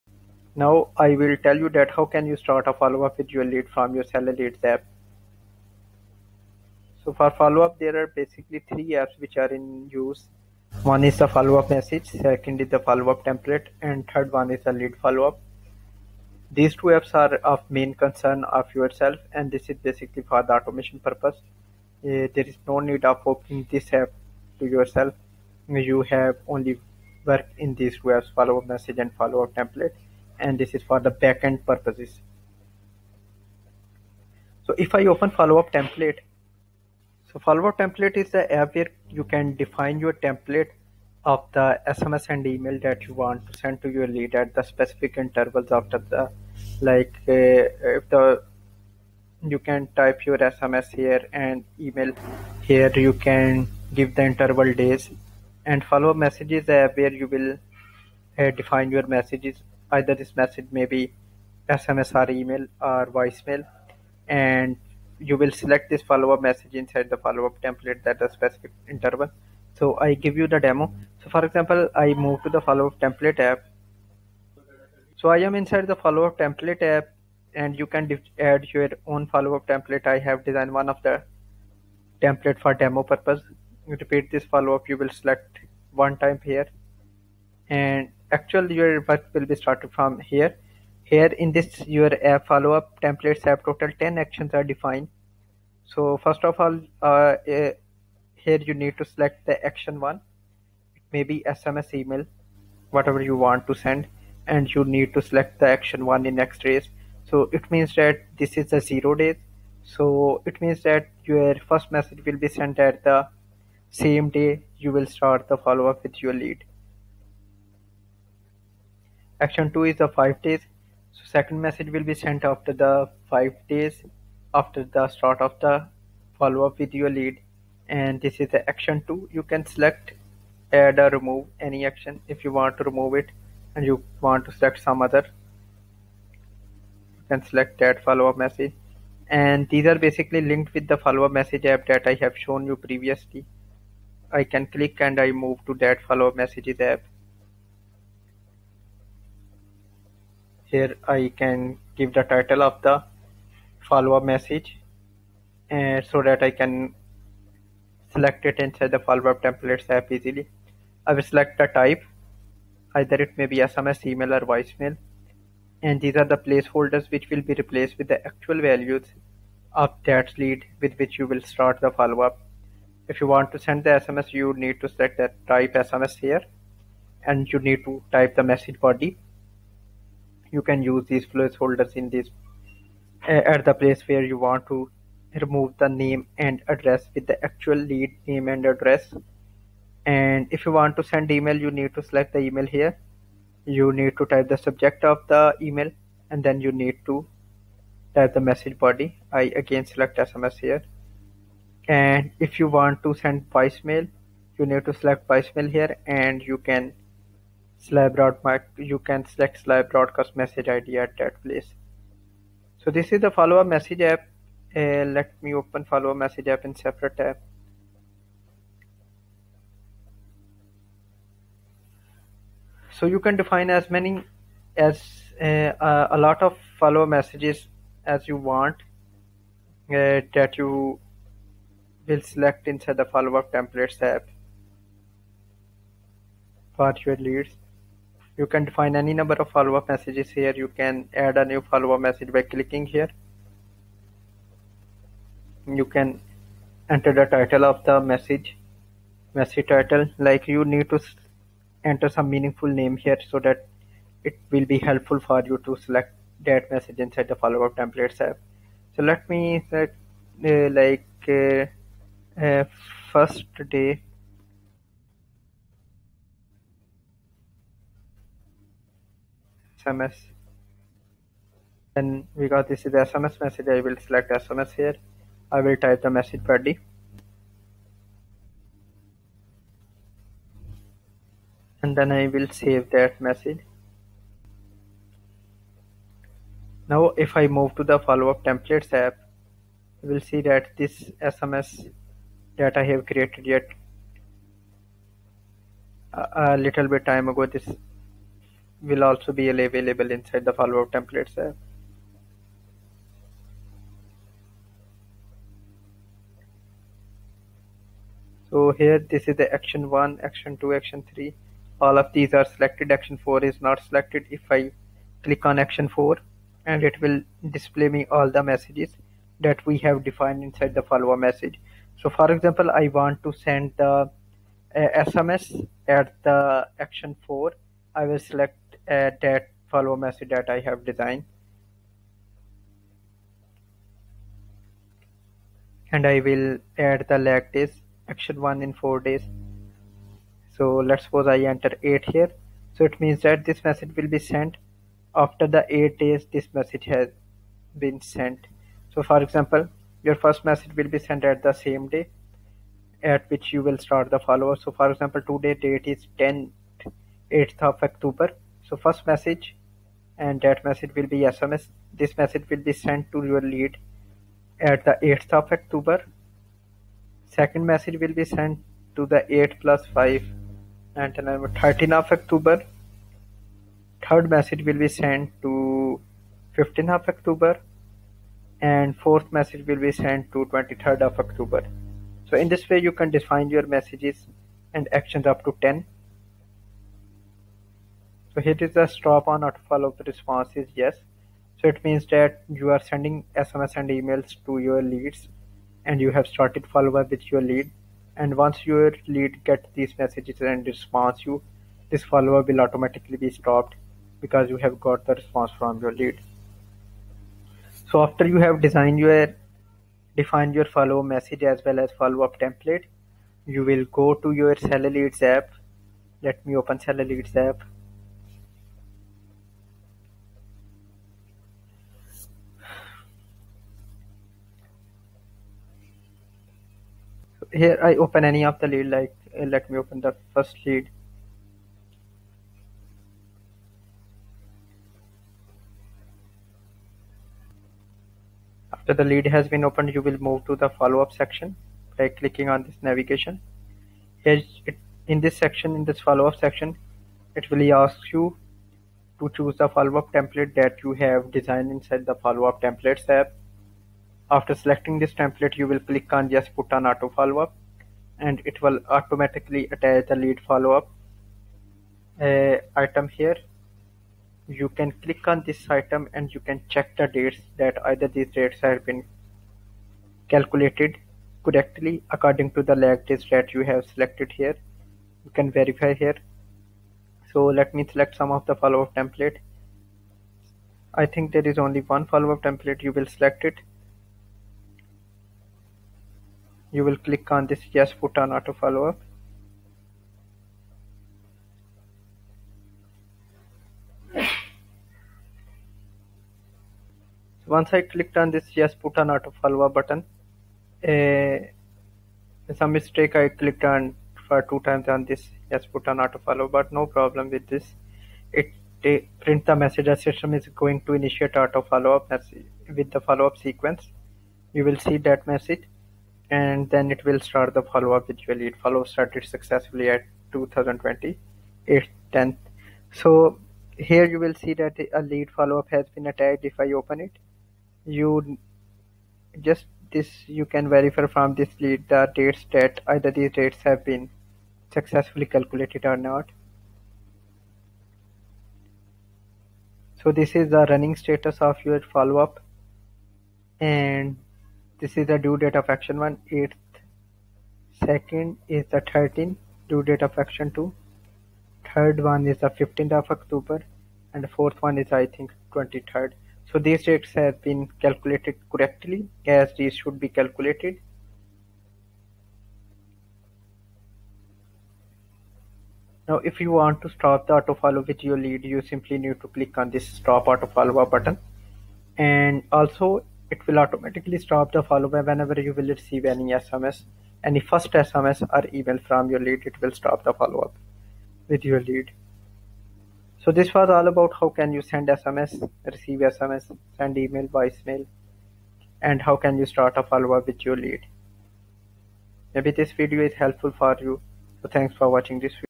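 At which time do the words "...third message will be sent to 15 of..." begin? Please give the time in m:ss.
6:14.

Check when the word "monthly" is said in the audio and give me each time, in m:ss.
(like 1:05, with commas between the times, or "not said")
not said.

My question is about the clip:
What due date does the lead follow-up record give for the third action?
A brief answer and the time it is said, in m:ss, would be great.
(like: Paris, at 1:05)
15 October, at 9:12.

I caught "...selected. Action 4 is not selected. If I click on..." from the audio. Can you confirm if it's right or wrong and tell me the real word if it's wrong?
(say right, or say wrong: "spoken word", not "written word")
right.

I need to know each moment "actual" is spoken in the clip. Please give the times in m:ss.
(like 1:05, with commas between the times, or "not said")
1:28, 2:48, 3:07.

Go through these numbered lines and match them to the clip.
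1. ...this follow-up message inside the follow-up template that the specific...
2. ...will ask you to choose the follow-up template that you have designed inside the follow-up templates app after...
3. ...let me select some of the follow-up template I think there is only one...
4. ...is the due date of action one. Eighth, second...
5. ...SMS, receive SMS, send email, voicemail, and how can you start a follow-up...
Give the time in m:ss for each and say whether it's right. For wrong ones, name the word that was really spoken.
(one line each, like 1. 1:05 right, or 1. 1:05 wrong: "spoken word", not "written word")
1. 1:05 right
2. 7:27 right
3. 7:57 right
4. 9:04 right
5. 9:44 right.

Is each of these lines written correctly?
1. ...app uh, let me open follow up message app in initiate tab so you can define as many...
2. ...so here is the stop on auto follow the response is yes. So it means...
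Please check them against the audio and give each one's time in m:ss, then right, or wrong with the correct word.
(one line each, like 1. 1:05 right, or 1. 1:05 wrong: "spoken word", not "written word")
1. 3:34 wrong: "separate", not "initiate"
2. 6:28 right.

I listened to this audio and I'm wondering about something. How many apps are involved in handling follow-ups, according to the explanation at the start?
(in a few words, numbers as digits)
3.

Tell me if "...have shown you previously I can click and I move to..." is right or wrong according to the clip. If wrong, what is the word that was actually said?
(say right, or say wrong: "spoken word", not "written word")
right.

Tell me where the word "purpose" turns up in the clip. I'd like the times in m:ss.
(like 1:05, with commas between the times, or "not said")
0:20, 0:31, 1:23.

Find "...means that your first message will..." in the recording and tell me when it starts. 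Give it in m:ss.
1:50.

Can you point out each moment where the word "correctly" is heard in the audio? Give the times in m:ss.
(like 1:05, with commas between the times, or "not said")
7:51, 9:18.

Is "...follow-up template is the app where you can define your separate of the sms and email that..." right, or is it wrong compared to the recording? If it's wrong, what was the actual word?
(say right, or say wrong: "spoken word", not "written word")
wrong: "template", not "separate".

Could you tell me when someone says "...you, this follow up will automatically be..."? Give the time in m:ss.
6:41.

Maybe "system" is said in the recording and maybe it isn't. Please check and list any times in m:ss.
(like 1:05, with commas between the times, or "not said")
8:30.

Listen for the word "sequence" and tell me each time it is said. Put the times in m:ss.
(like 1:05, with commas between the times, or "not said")
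8:33.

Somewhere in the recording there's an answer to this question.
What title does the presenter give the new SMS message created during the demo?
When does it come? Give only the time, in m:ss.
4:23.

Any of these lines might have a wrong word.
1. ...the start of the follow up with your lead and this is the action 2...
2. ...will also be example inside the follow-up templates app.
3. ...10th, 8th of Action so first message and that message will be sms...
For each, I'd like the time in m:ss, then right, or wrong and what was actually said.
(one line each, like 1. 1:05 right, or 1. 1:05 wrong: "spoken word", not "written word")
1. 2:04 right
2. 4:58 wrong: "available", not "example"
3. 5:56 wrong: "October", not "Action".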